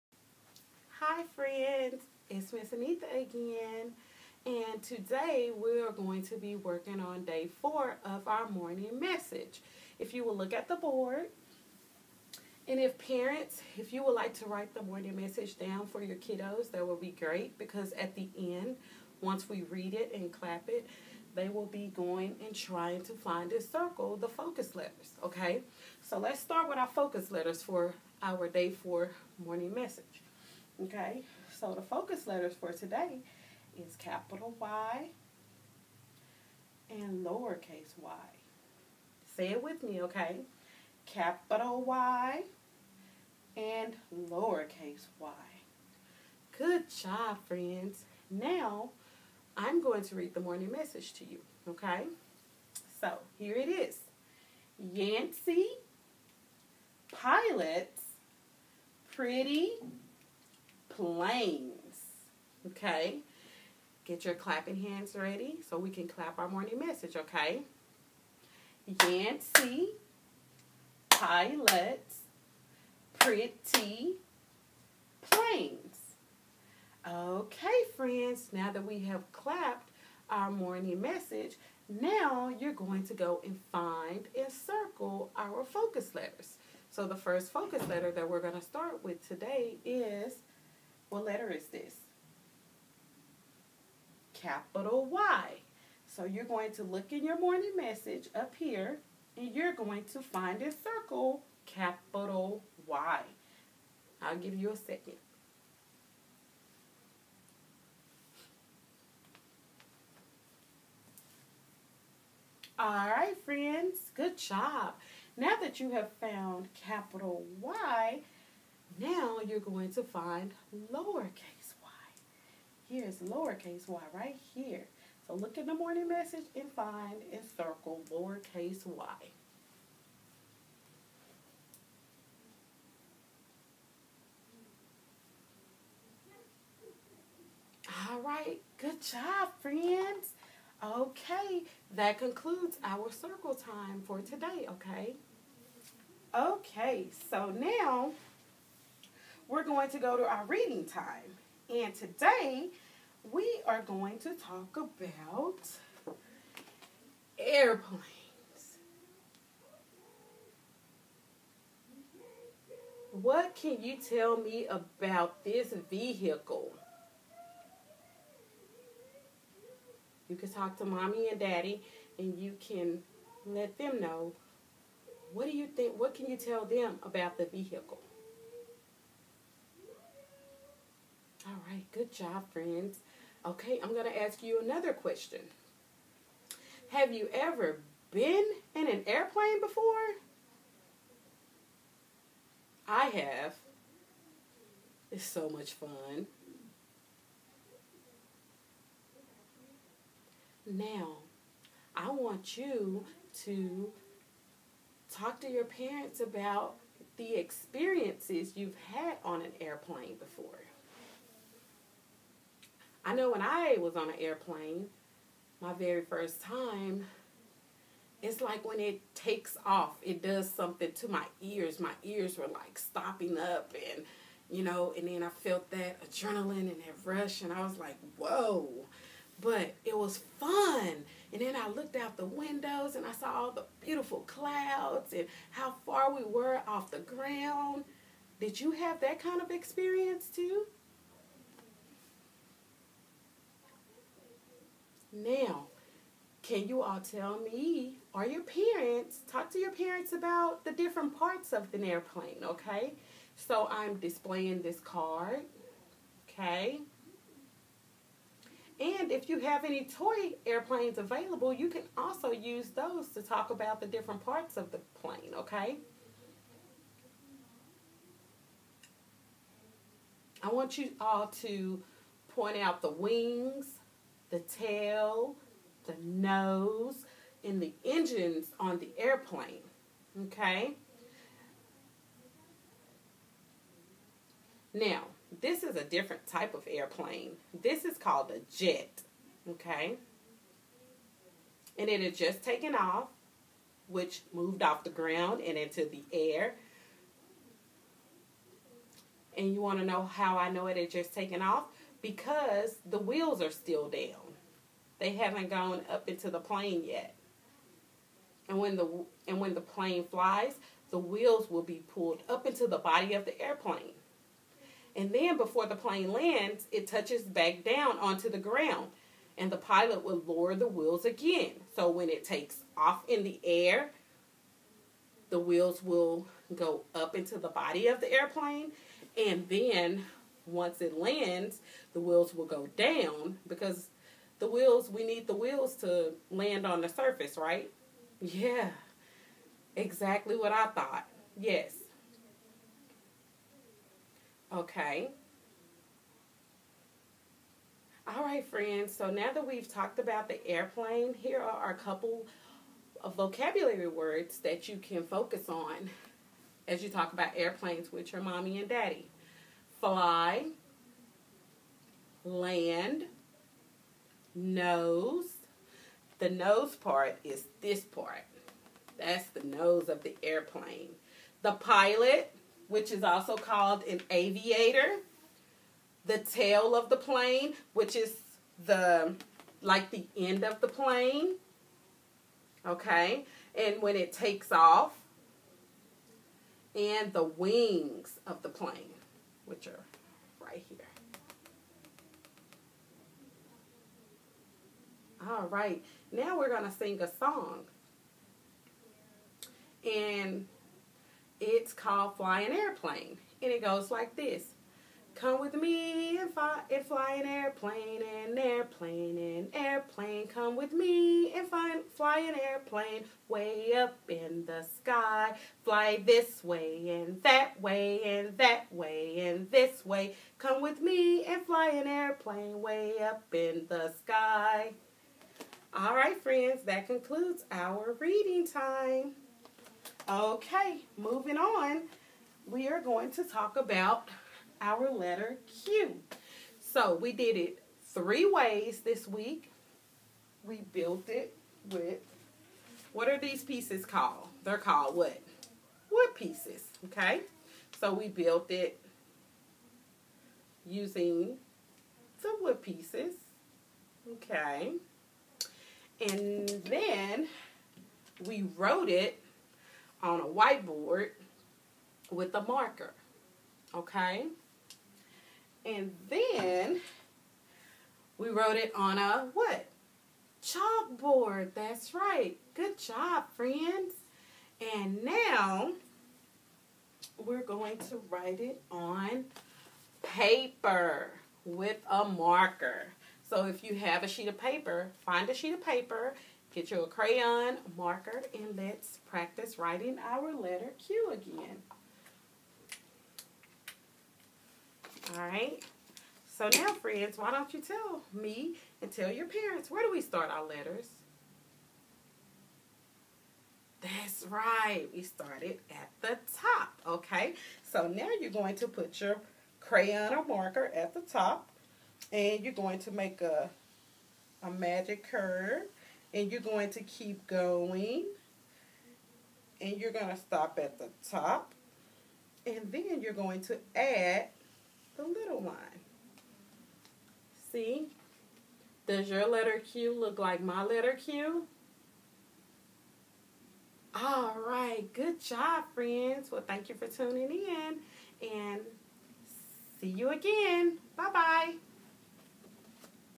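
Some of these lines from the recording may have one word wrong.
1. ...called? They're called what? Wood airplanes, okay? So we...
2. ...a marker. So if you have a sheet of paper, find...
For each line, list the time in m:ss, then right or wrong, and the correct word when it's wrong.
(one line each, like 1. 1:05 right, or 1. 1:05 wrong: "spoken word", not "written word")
1. 7:23 wrong: "pieces", not "airplanes"
2. 8:01 right.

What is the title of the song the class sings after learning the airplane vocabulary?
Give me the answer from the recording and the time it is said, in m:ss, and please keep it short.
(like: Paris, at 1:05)
Flying Airplane, at 6:42.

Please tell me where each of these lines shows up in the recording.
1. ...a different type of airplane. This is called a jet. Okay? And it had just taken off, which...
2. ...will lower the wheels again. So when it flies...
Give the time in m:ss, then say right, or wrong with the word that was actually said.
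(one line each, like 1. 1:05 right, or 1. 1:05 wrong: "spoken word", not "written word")
1. 4:45 right
2. 5:20 wrong: "takes", not "flies".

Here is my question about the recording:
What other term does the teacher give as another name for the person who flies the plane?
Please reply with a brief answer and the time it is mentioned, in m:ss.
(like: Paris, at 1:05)
Aviator, at 6:14.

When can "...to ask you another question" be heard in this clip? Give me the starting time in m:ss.
3:04.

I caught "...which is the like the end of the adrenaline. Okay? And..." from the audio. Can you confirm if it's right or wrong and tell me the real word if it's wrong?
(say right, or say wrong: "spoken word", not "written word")
wrong: "plane", not "adrenaline".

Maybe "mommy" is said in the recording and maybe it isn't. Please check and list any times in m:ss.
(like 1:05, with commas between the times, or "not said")
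2:50, 5:58.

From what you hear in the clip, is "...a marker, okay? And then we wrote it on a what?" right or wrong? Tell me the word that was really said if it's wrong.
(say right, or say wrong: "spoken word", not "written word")
right.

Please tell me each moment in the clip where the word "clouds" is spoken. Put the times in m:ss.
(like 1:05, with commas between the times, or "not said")
3:54.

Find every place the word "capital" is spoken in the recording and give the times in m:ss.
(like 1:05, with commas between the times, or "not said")
0:33, 0:41, 1:34, 1:41, 1:56.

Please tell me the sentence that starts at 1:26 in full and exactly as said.
So the first focus letter that we're going to start with today is what letter is this?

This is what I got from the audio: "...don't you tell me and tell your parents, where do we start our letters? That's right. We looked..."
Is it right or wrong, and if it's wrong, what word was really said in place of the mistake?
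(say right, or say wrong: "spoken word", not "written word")
wrong: "started", not "looked".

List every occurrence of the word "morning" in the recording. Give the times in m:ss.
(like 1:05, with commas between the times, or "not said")
0:08, 0:14, 0:29, 0:50, 1:06, 1:20, 1:37, 2:05.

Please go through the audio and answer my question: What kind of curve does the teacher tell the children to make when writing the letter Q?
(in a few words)
Magic curve.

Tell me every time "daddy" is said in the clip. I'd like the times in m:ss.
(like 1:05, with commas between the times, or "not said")
2:51, 5:58.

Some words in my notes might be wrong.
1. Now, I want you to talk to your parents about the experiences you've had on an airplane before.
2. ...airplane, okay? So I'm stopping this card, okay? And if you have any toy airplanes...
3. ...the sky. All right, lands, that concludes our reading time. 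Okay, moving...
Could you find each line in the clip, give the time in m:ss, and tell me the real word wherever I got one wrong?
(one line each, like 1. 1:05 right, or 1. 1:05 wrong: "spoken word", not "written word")
1. 3:20 right
2. 4:11 wrong: "displaying", not "stopping"
3. 7:03 wrong: "friends", not "lands".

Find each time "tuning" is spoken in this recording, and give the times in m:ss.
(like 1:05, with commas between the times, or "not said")
8:56.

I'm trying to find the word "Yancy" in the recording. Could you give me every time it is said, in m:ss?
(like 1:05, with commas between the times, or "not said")
0:54, 1:09.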